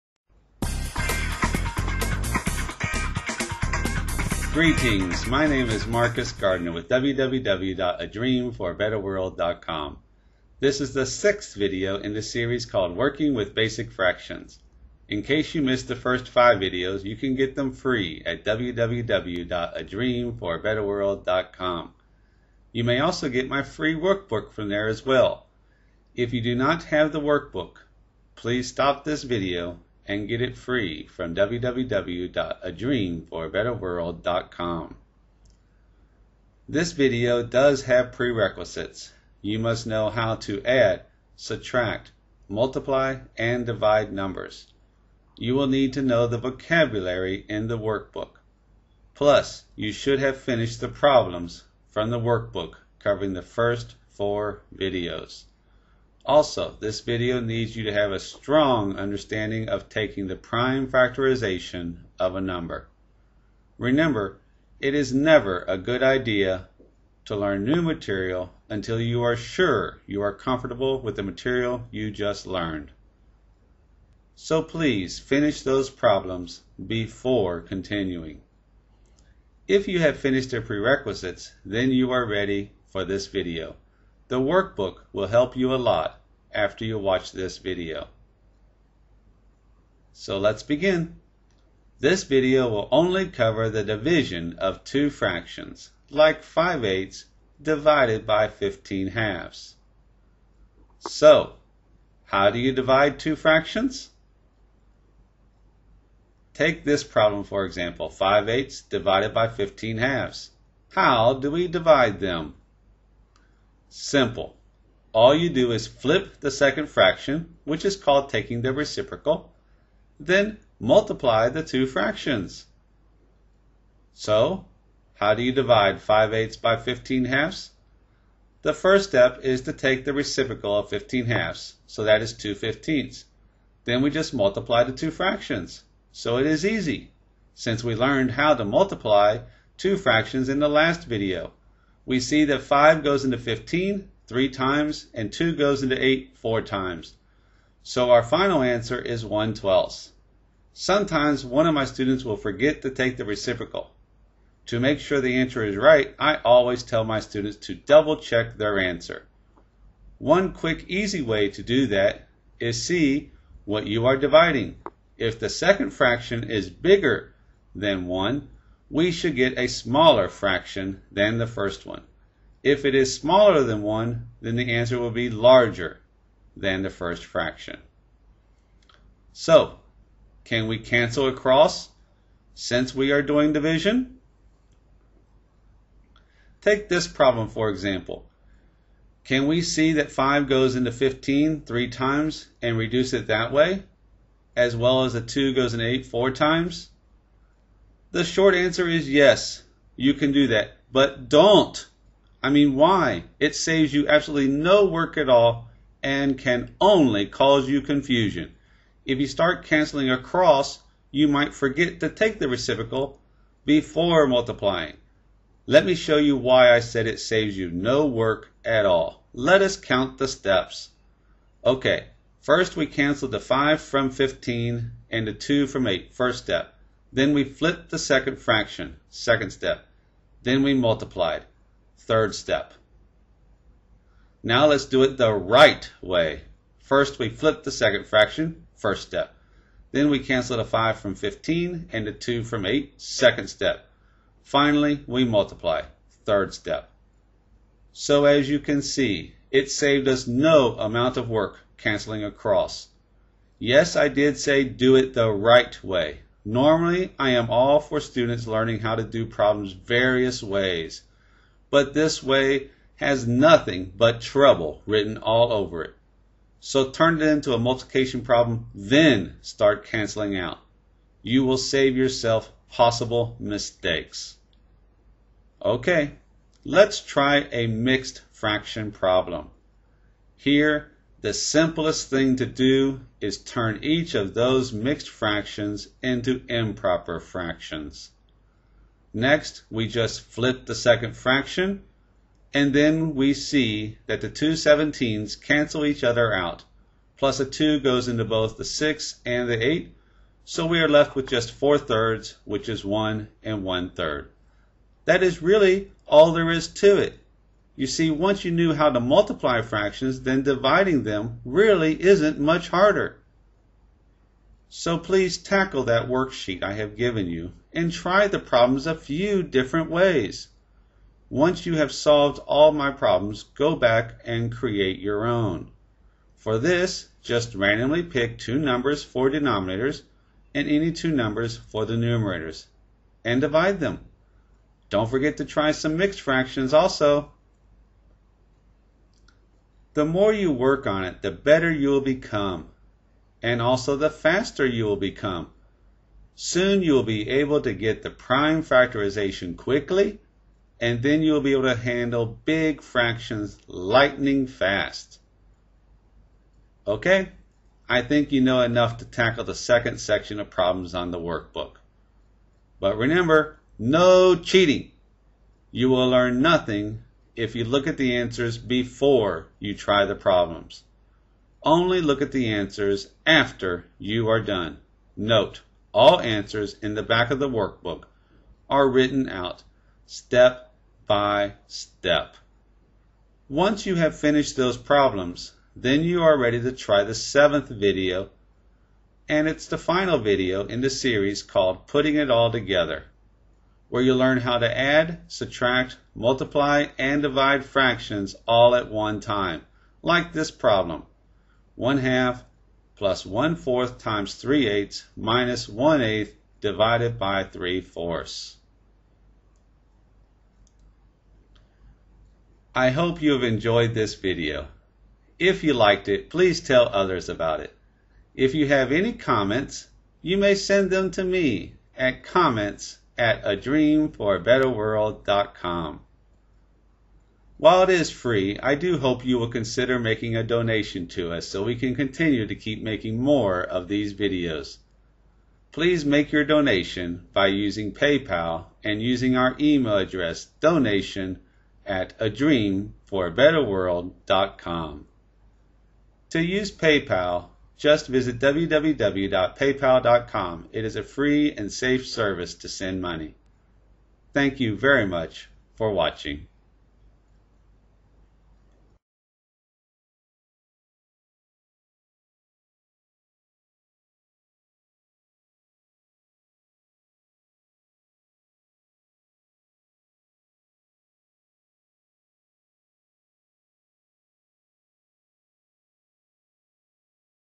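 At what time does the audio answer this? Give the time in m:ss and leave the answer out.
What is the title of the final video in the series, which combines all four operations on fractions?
6:31.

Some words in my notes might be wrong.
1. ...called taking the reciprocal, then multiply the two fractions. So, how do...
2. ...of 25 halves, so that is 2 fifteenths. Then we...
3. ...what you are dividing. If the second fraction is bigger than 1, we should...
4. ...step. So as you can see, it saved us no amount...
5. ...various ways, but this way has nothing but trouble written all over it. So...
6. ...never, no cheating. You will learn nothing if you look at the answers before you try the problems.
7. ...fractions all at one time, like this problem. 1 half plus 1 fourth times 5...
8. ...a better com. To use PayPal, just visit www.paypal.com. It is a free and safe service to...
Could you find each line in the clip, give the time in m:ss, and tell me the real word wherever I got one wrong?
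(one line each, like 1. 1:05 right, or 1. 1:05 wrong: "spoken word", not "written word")
1. 1:57 right
2. 2:10 wrong: "15", not "25"
3. 2:43 right
4. 4:06 right
5. 4:19 right
6. 6:02 wrong: "remember", not "never"
7. 6:37 wrong: "3", not "5"
8. 7:23 right.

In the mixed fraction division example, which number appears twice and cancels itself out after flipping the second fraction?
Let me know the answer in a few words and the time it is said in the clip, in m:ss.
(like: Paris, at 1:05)
17, at 4:54.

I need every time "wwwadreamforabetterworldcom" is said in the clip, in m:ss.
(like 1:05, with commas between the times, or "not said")
0:06, 0:18, 0:31.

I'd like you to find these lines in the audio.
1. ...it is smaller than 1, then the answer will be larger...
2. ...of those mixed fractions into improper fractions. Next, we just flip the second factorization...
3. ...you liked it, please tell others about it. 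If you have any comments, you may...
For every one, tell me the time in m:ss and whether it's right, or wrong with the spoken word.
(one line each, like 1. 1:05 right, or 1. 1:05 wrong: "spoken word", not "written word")
1. 2:52 right
2. 4:44 wrong: "fraction", not "factorization"
3. 6:55 right.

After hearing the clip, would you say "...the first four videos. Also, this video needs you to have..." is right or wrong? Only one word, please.
right.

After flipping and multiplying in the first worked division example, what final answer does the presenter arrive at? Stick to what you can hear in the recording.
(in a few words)
1/12.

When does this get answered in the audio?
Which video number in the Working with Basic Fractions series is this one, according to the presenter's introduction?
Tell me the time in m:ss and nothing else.
0:11.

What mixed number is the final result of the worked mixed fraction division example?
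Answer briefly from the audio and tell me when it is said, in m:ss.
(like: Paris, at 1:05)
1 and 1/3, at 5:02.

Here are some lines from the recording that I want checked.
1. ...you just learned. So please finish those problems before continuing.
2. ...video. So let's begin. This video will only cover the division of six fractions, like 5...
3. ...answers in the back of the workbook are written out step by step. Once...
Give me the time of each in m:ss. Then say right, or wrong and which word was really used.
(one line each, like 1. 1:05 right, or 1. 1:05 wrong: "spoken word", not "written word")
1. 1:11 right
2. 1:27 wrong: "two", not "six"
3. 6:16 right.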